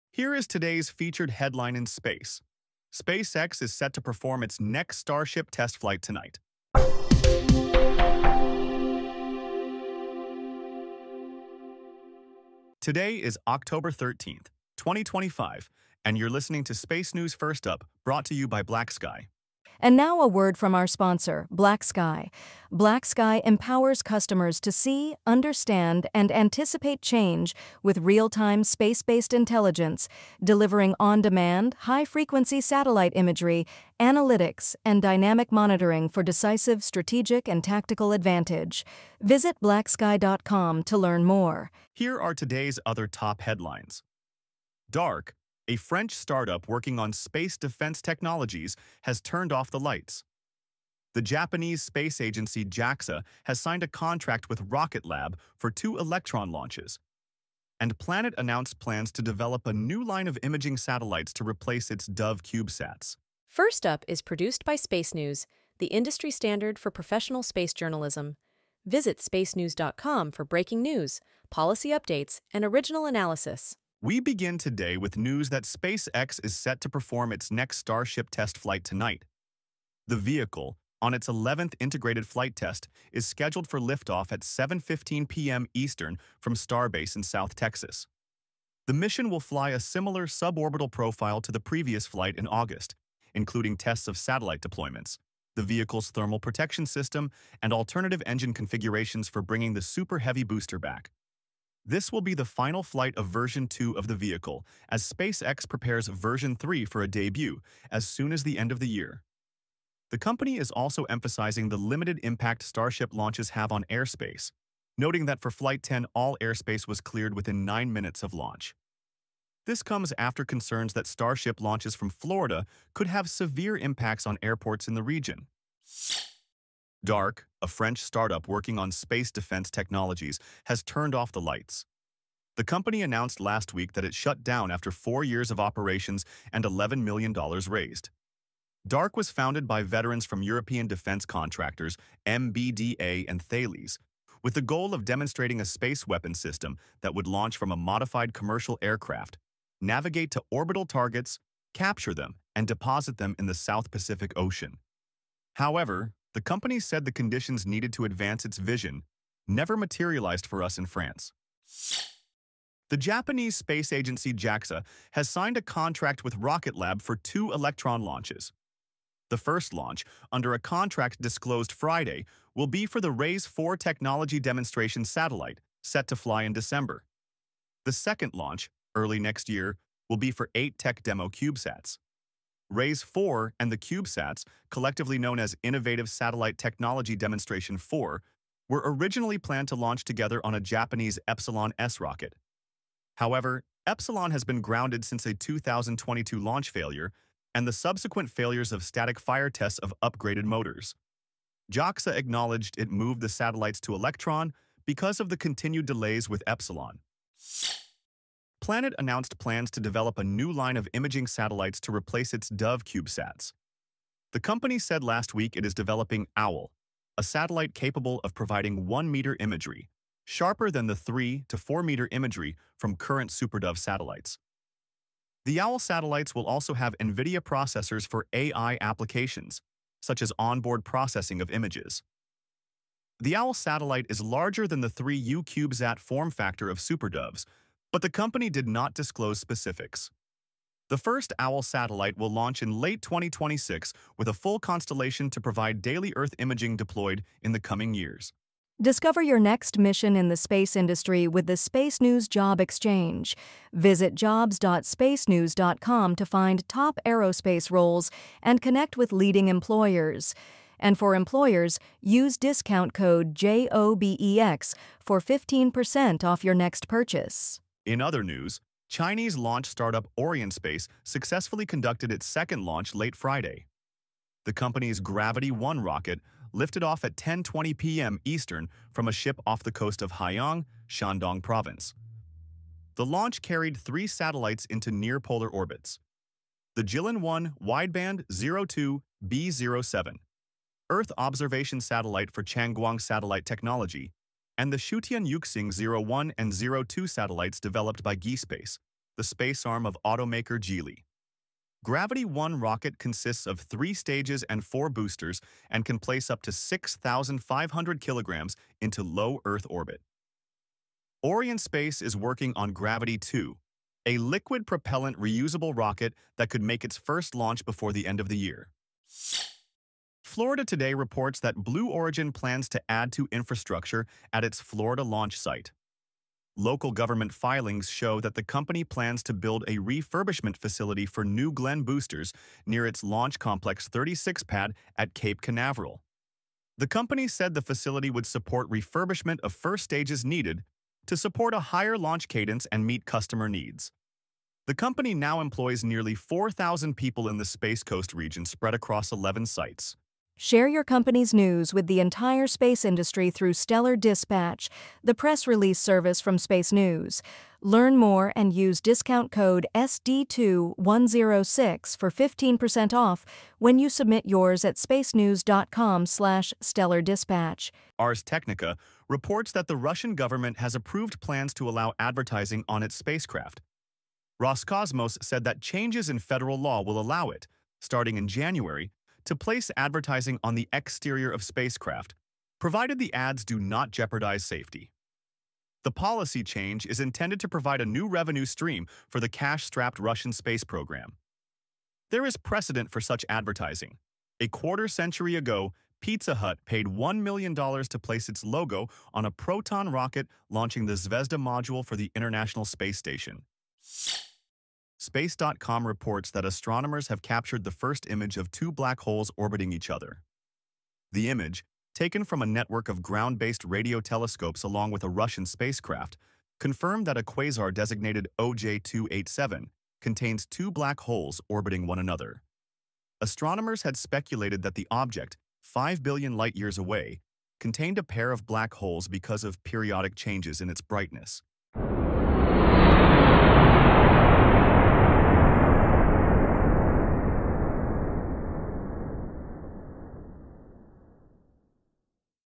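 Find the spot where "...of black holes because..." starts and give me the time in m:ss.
7:08.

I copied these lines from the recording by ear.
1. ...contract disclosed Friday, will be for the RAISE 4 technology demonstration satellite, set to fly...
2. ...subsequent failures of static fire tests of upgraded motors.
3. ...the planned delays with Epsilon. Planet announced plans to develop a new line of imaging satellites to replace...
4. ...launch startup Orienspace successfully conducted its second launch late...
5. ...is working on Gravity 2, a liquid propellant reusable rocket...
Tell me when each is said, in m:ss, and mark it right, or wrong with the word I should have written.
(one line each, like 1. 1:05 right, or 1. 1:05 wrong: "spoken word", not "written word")
1. 2:50 right
2. 3:17 right
3. 3:25 wrong: "continued", not "planned"
4. 4:29 right
5. 5:12 right.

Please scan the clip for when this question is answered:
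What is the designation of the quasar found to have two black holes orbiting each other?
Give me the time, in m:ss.
6:58.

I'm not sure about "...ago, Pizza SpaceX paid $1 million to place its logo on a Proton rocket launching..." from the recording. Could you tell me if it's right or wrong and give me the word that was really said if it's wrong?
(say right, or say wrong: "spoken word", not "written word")
wrong: "Hut", not "SpaceX".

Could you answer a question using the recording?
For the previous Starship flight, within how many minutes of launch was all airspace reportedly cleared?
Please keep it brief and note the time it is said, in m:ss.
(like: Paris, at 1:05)
9 minutes, at 1:57.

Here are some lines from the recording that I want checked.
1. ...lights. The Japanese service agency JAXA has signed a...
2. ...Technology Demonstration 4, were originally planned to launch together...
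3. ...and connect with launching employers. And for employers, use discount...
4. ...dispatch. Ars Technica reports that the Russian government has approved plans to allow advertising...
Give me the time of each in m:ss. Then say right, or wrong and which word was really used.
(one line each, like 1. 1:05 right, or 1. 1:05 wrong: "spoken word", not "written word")
1. 0:49 wrong: "space", not "service"
2. 3:06 right
3. 4:18 wrong: "leading", not "launching"
4. 6:07 right.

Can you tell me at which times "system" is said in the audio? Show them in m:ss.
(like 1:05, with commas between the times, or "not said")
1:36, 2:26.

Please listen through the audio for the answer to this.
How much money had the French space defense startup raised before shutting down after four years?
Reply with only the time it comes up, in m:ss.
2:16.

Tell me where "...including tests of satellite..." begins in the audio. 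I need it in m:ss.
1:33.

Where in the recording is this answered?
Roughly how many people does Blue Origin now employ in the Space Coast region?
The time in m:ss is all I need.
5:45.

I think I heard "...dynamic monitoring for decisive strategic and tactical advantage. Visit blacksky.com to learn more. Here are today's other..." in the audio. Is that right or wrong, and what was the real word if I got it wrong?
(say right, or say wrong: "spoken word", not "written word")
right.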